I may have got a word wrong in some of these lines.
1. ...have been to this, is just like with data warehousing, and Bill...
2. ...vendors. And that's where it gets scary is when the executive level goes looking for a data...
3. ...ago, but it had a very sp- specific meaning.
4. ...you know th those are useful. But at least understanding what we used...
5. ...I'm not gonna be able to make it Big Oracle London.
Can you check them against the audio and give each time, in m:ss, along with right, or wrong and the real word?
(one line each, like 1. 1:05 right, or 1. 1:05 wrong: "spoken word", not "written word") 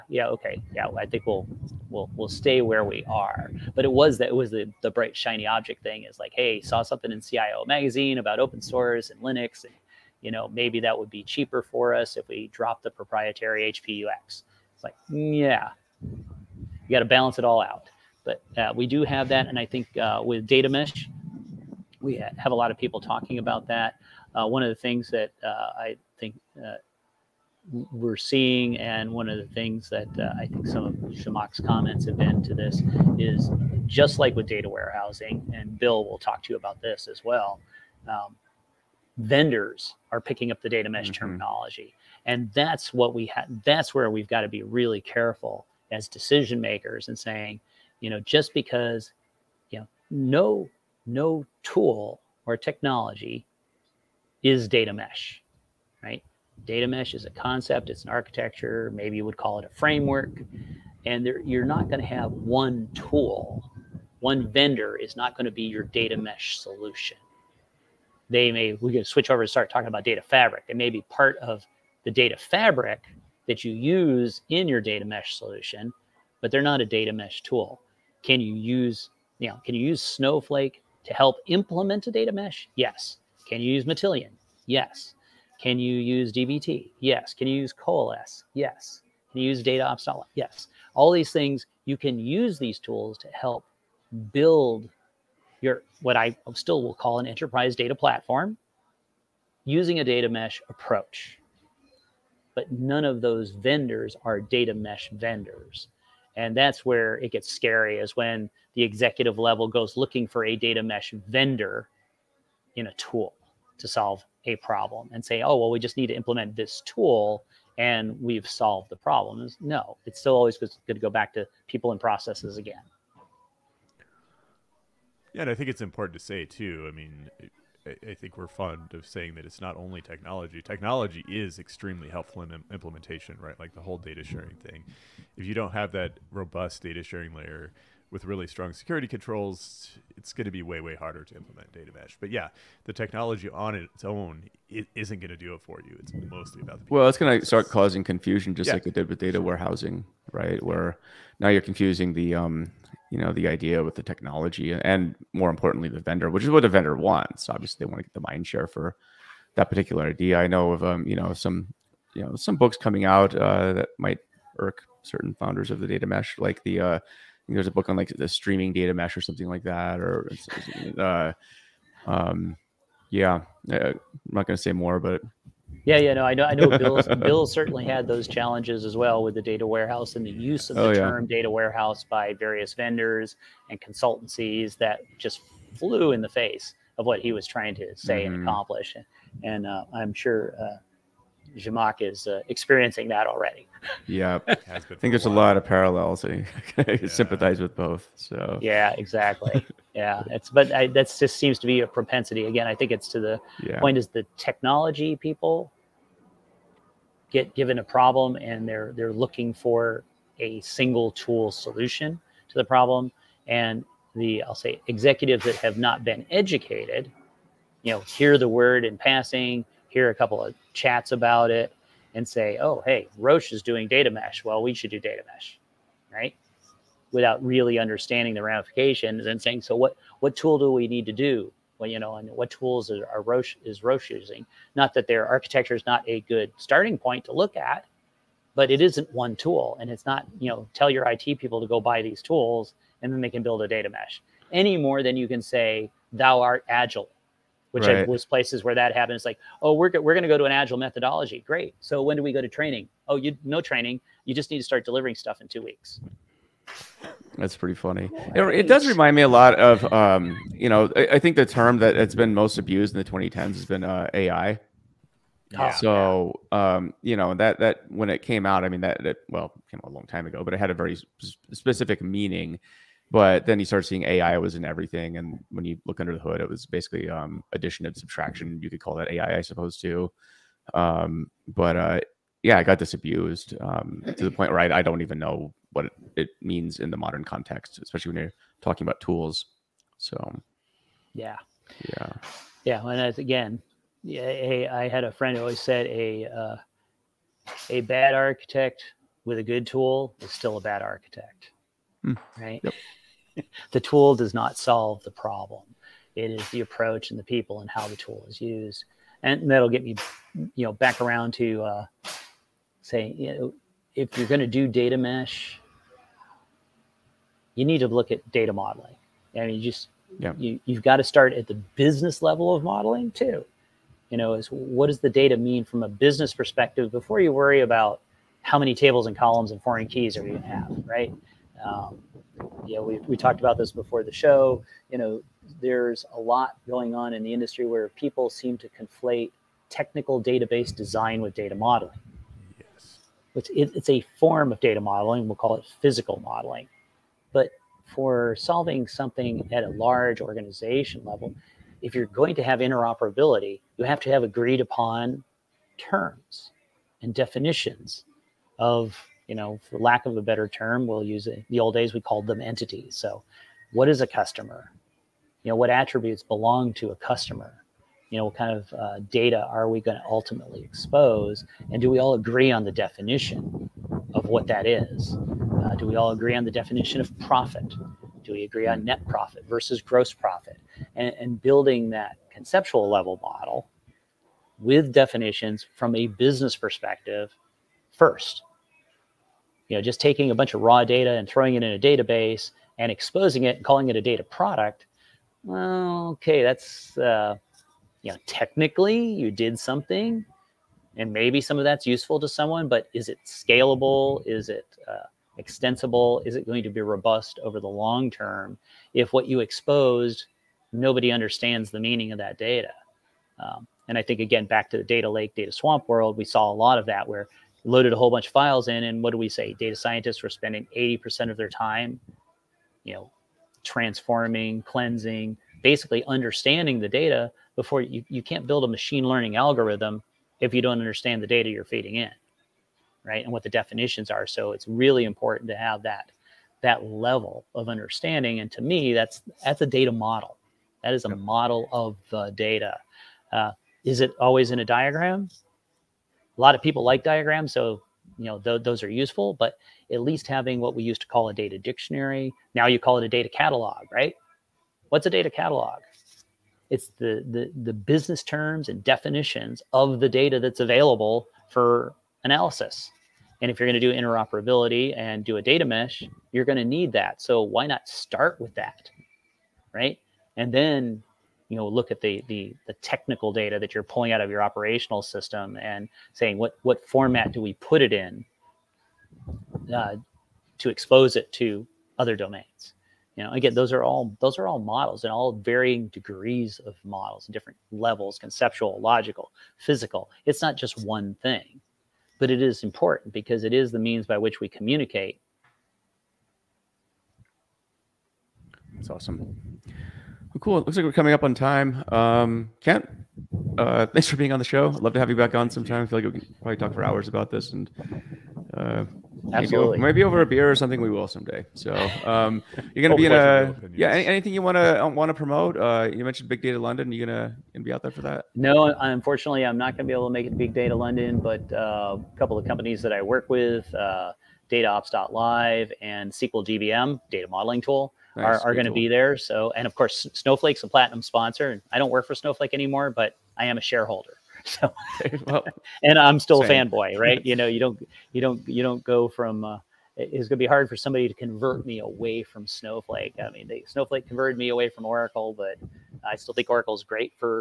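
1. 0:32 right
2. 1:45 right
3. 4:30 right
4. 7:28 wrong: "having", not "understanding"
5. 8:39 wrong: "Data", not "Oracle".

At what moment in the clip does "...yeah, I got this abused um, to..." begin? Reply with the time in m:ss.
4:42.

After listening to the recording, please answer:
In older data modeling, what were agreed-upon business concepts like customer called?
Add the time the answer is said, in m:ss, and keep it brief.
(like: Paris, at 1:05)
Entities, at 6:02.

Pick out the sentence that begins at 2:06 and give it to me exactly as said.
I mean, I think we're fond of saying that it's not only technology.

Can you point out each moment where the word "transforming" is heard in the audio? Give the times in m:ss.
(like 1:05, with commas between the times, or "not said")
7:03.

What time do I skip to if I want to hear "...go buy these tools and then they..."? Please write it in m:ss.
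4:01.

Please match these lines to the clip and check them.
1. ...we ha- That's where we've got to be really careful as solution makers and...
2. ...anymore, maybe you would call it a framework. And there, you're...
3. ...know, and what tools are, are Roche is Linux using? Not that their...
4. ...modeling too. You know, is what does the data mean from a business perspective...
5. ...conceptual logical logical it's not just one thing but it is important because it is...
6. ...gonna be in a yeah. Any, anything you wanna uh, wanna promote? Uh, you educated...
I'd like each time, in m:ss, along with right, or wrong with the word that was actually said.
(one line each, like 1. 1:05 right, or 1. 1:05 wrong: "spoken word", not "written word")
1. 0:43 wrong: "decision", not "solution"
2. 0:58 wrong: "architecture", not "anymore"
3. 3:51 wrong: "Roche", not "Linux"
4. 5:22 right
5. 8:08 wrong: "physical", not "logical"
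6. 8:32 wrong: "mentioned", not "educated".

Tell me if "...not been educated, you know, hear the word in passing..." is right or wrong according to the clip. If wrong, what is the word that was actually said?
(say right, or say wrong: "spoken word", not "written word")
right.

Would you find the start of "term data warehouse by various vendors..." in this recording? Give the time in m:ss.
3:01.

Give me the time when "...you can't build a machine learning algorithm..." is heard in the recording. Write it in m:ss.
7:08.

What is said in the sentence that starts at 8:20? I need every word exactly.
It looks like we're coming up on time.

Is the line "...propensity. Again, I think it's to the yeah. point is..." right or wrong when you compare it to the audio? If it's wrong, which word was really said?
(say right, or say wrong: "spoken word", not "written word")
right.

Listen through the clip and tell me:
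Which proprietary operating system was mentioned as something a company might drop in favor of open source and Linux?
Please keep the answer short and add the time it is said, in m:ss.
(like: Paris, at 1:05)
HP UX, at 0:13.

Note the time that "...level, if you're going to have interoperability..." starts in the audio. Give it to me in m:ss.
5:51.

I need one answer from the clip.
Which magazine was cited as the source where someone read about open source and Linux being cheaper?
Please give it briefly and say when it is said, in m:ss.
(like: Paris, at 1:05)
CIO magazine, at 0:07.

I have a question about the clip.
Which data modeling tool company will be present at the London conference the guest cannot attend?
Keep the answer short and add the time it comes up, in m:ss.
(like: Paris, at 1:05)
SQL DBM, at 8:46.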